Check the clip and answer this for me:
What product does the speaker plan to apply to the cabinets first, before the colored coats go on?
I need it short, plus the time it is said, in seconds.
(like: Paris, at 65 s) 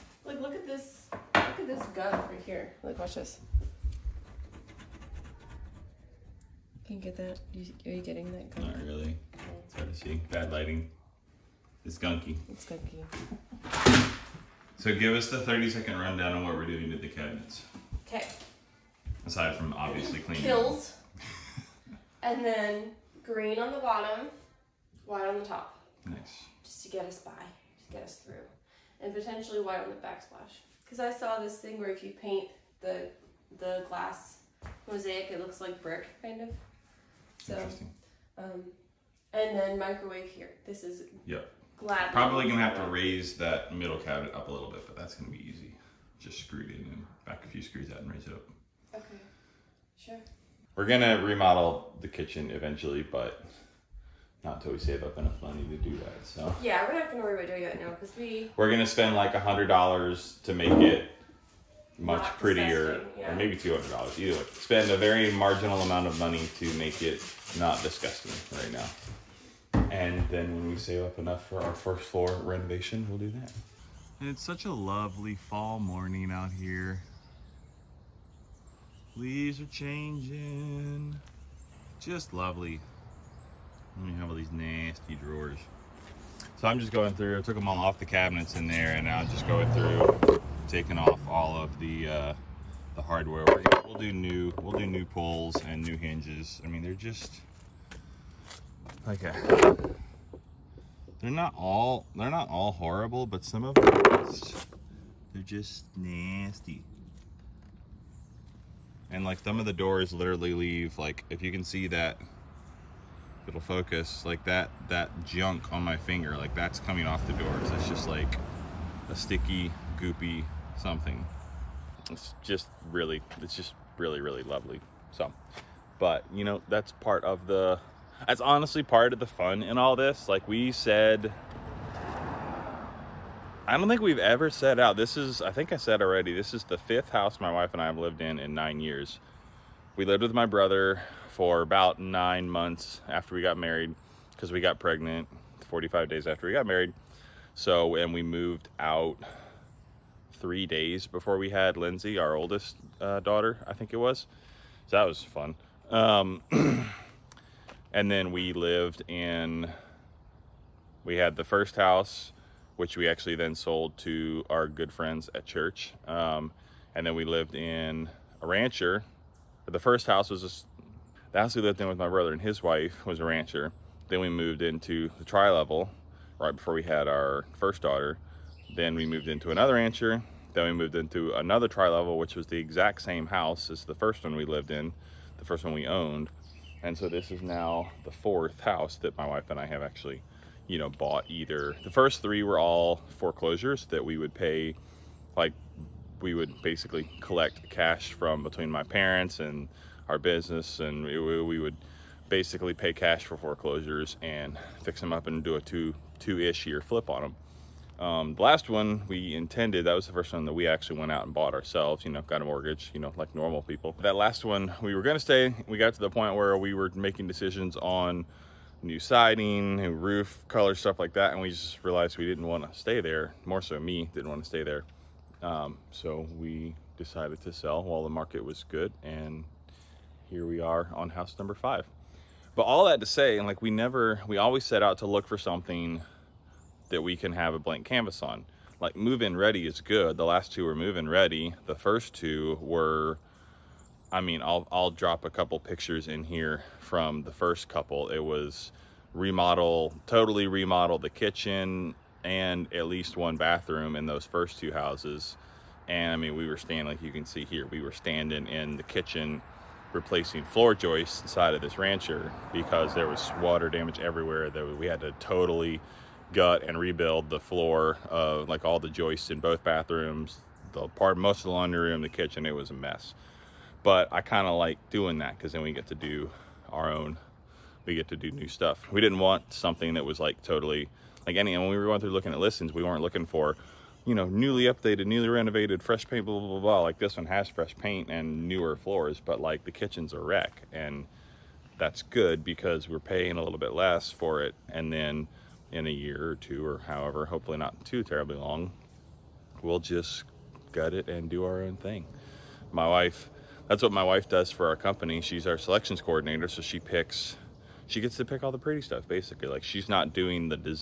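Kilz, at 20 s.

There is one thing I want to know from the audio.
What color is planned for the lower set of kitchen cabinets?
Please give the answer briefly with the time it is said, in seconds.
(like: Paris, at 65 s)
Green, at 23 s.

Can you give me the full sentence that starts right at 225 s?
Um, so we decided to sell while the market was good.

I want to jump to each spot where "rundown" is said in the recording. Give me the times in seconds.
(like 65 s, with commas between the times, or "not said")
15 s.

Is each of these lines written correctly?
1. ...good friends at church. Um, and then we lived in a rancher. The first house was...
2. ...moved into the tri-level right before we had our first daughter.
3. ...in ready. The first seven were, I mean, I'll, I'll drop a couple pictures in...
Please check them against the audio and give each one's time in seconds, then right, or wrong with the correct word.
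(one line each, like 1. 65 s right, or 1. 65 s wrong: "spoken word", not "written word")
1. 164 s right
2. 174 s right
3. 240 s wrong: "two", not "seven".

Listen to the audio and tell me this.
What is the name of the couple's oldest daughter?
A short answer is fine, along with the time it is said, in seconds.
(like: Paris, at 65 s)
Lindsay, at 151 s.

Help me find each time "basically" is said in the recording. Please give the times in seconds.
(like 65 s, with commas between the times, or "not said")
196 s, 202 s, 309 s.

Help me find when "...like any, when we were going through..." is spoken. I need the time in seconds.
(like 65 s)
281 s.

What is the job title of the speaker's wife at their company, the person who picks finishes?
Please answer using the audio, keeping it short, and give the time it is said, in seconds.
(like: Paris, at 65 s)
Selections coordinator, at 305 s.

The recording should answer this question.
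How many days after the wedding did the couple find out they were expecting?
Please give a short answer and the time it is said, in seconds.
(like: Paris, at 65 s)
45, at 145 s.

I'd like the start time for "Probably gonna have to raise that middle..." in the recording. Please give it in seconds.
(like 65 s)
42 s.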